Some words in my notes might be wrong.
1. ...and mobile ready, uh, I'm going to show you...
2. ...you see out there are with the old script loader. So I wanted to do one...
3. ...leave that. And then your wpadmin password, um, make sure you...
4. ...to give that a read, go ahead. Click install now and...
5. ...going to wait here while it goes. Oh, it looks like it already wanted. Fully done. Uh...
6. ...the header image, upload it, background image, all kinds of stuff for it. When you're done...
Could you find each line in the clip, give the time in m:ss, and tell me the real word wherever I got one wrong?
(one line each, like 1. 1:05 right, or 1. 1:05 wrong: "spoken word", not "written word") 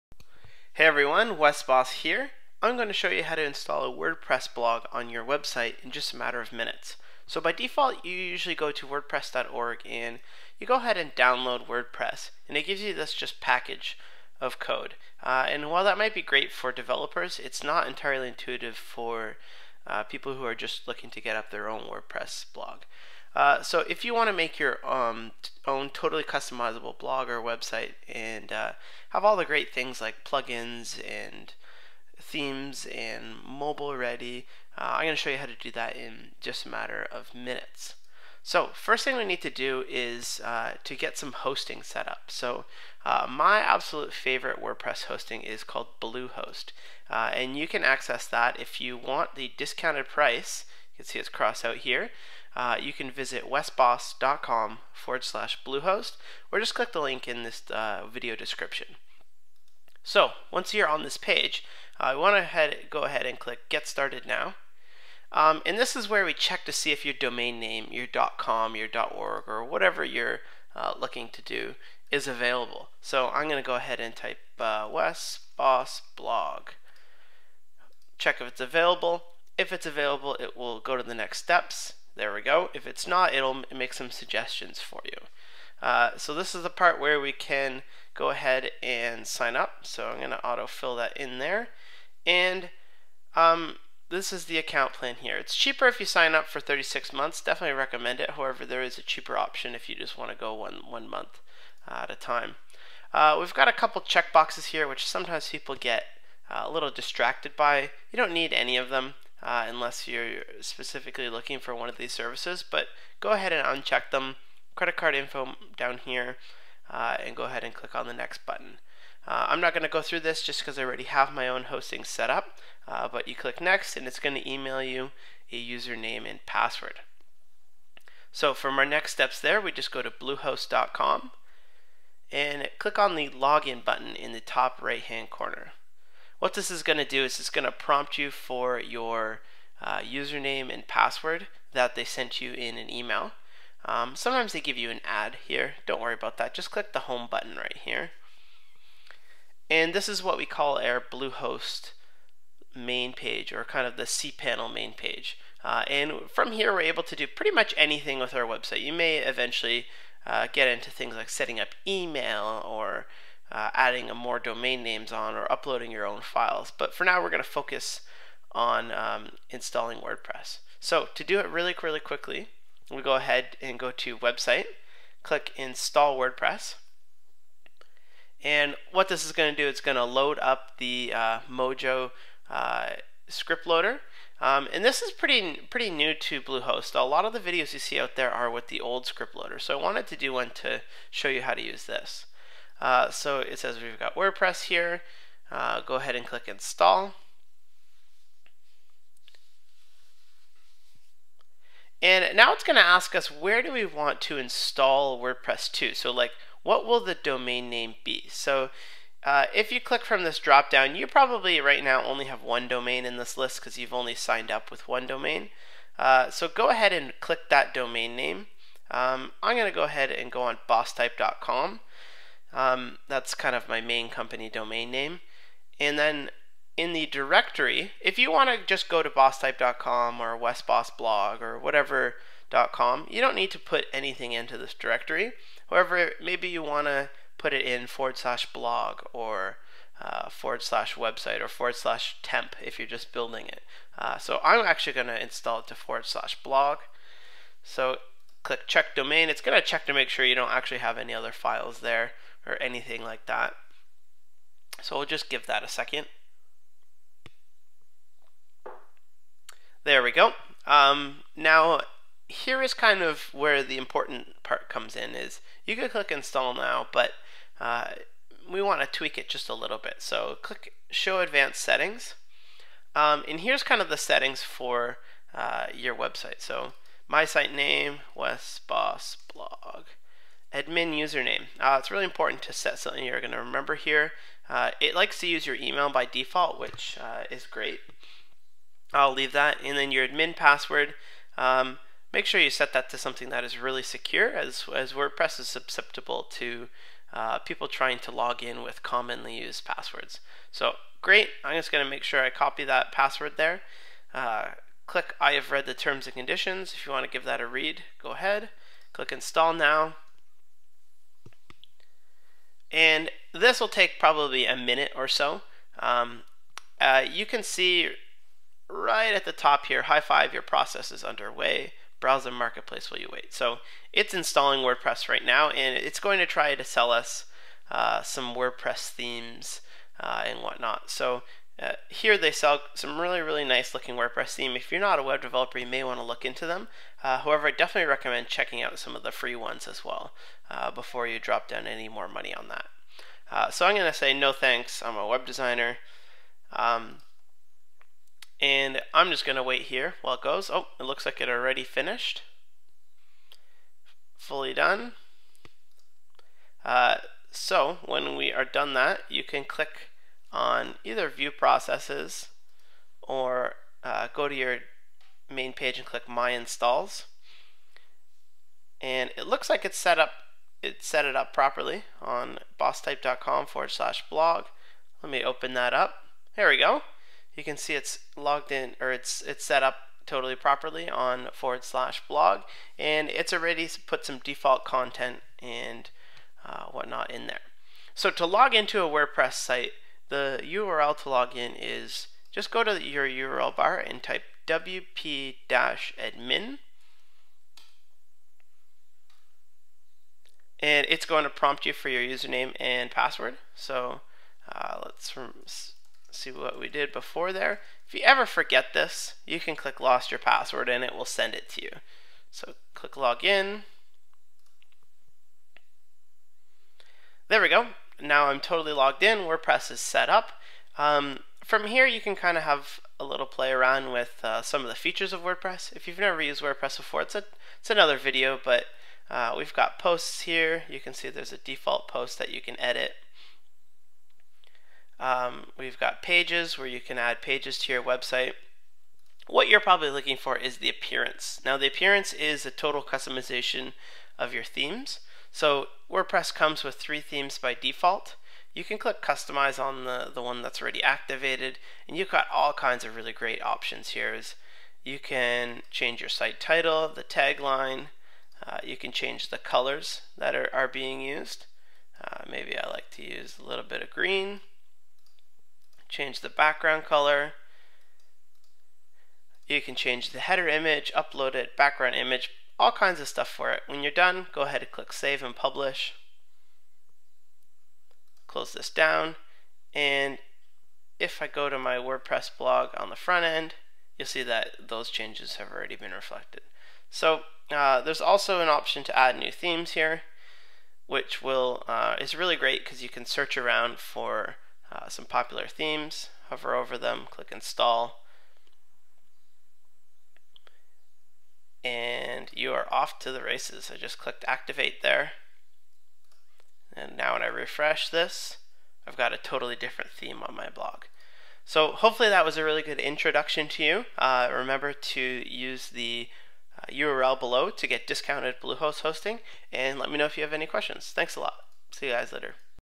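1. 0:32 right
2. 3:07 right
3. 4:49 wrong: "admin", not "wpadmin"
4. 5:07 right
5. 5:49 wrong: "finished", not "wanted"
6. 7:50 right.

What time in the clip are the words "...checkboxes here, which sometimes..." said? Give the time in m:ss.
1:44.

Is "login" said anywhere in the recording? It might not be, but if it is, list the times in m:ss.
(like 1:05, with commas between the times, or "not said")
2:13, 6:52.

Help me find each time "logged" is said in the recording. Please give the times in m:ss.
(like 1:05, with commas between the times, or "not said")
6:18, 6:58.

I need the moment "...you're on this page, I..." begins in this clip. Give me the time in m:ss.
1:00.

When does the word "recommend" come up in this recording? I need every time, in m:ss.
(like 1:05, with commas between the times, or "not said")
1:37, 5:37.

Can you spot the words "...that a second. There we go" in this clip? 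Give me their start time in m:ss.
4:15.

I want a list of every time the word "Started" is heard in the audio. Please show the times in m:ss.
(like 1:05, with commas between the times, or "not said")
1:03.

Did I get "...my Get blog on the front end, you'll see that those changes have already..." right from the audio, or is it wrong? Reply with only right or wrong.
wrong.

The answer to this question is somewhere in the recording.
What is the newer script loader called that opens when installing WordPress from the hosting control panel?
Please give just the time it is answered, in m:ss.
3:01.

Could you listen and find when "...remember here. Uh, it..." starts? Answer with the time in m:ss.
4:43.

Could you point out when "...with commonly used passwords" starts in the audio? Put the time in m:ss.
4:58.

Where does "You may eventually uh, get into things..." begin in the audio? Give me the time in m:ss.
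2:38.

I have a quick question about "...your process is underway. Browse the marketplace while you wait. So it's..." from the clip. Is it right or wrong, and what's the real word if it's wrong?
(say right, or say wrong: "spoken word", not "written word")
right.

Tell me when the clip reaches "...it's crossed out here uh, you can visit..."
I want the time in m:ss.
0:51.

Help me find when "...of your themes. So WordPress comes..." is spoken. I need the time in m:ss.
7:24.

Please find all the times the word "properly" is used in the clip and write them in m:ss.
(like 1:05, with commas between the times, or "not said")
6:11, 6:20.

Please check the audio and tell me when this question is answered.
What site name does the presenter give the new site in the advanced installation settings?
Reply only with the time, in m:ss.
4:38.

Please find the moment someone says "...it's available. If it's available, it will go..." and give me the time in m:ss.
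1:18.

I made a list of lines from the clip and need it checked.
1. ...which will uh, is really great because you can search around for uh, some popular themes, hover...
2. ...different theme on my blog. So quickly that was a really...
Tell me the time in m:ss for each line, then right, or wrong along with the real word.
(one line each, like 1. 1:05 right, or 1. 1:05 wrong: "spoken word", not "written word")
1. 8:10 right
2. 8:29 wrong: "hopefully", not "quickly".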